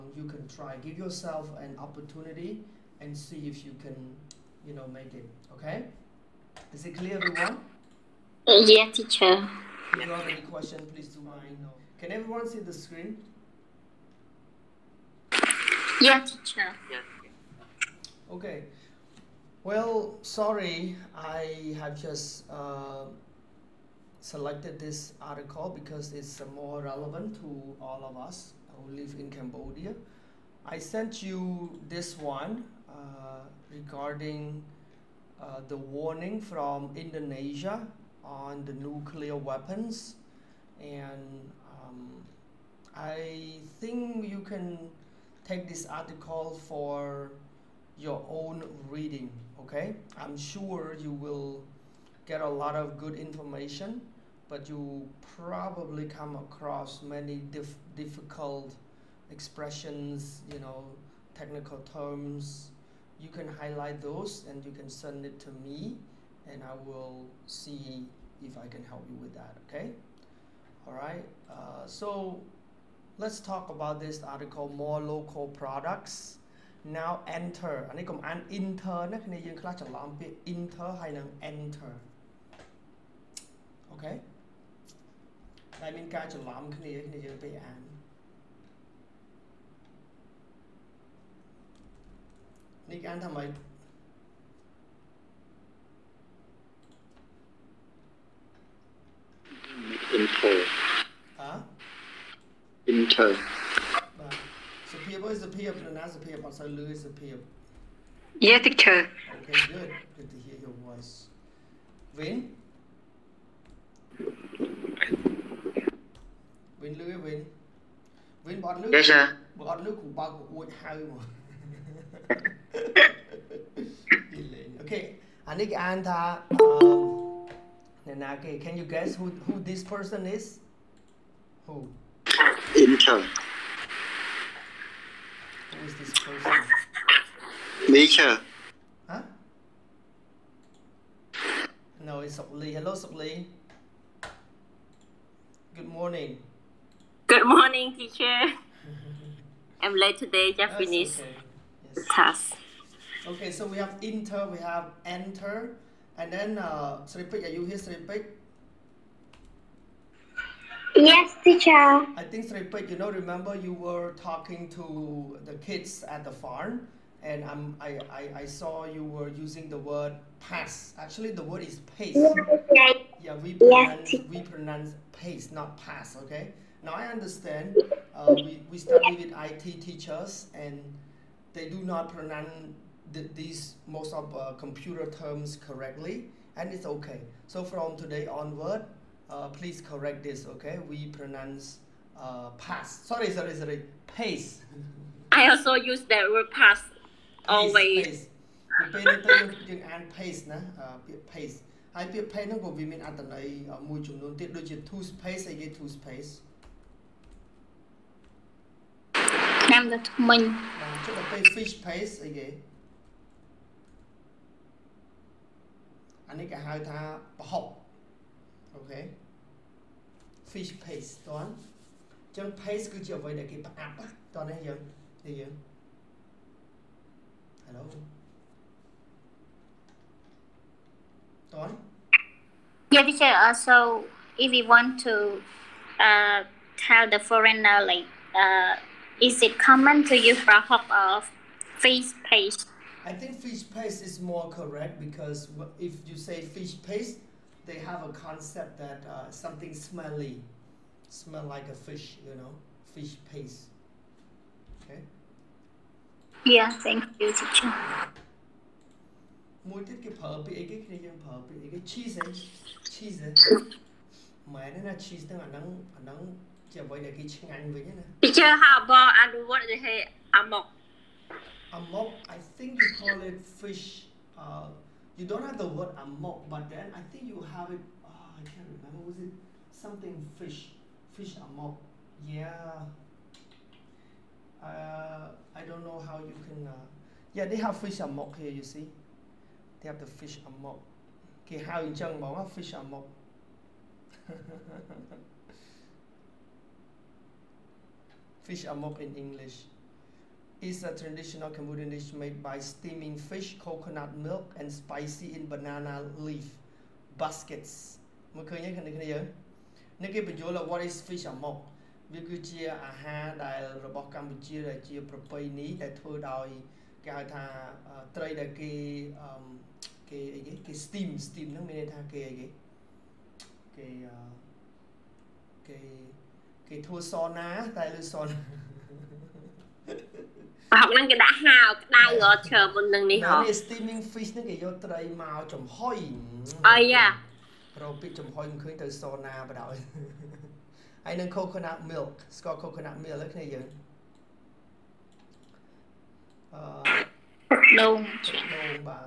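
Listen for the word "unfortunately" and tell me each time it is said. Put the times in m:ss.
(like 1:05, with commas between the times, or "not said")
not said.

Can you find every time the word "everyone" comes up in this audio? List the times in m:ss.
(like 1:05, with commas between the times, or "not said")
0:07, 0:12.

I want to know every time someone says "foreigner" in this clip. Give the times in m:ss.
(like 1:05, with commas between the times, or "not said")
3:57.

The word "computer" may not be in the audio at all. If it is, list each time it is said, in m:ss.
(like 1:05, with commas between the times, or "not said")
3:04.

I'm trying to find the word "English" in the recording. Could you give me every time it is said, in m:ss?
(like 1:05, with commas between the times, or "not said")
4:59.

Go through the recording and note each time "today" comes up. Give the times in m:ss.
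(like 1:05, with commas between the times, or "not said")
2:30, 3:07.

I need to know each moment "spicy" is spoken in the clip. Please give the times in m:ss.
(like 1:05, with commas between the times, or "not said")
5:04.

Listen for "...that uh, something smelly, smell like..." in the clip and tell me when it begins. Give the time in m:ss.
4:08.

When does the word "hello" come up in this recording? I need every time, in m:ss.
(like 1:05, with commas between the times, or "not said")
2:22, 3:47.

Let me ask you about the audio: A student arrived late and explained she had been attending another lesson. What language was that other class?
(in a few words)
Japanese.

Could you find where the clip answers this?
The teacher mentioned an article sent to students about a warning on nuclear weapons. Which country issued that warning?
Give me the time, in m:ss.
0:36.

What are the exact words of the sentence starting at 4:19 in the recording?
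Mỗi tiết cái phở bị cái này chẳng phở bị cái cheese ấy, cheese ấy.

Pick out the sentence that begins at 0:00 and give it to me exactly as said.
Give yourself an opportunity and see if you can you know make it.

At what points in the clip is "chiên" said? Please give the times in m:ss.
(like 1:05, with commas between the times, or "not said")
4:27.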